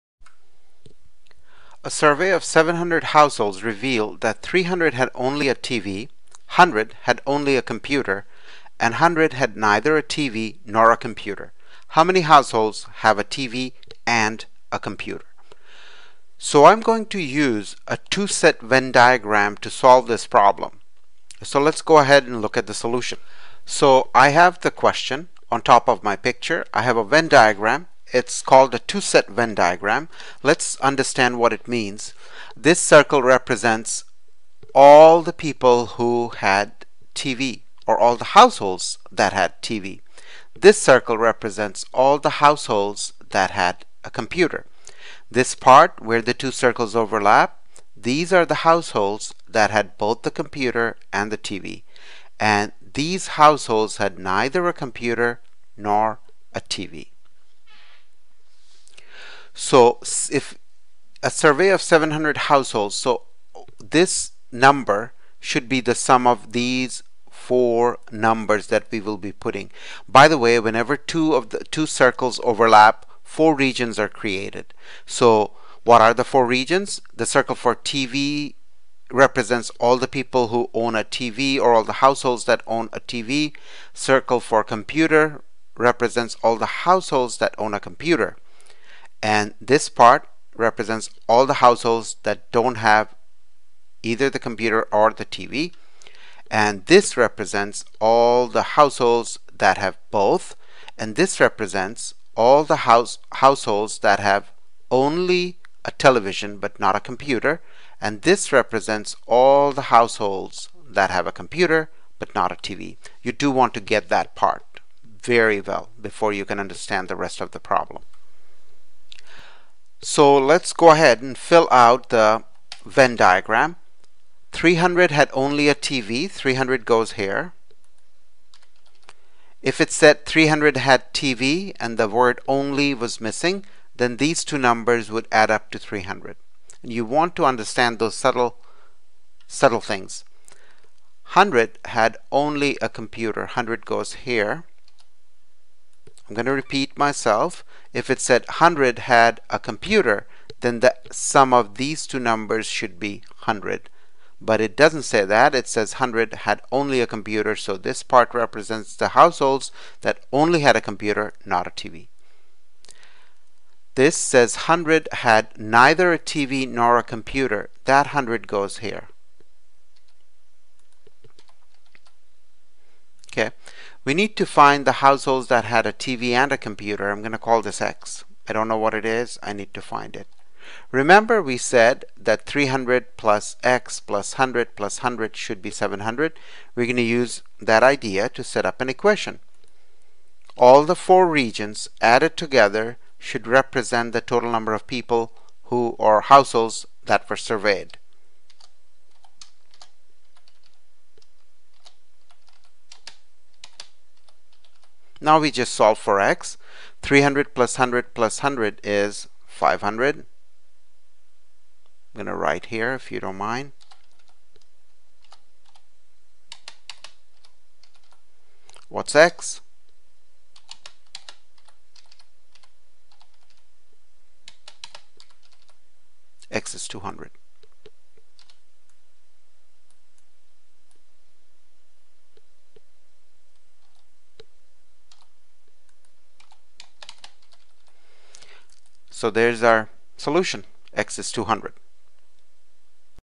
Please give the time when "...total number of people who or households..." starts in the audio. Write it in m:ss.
3:14.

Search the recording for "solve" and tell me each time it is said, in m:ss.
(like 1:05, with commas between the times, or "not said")
0:19, 3:25.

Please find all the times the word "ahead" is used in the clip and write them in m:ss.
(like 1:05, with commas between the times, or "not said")
0:21, 2:00.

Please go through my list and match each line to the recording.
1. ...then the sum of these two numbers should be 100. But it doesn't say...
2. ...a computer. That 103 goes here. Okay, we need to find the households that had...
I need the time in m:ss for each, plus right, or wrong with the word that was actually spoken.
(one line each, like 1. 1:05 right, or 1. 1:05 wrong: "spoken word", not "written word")
1. 2:30 right
2. 2:46 wrong: "100", not "103".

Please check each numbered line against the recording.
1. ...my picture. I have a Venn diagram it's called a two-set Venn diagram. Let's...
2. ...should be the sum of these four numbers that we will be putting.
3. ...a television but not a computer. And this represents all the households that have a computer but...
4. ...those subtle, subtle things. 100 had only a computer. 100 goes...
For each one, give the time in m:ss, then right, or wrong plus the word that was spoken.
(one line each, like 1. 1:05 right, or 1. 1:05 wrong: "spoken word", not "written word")
1. 0:26 right
2. 1:05 right
3. 1:45 right
4. 2:17 right.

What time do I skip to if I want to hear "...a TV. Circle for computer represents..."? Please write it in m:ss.
1:22.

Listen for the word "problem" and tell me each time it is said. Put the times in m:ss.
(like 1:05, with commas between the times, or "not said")
0:20, 1:57.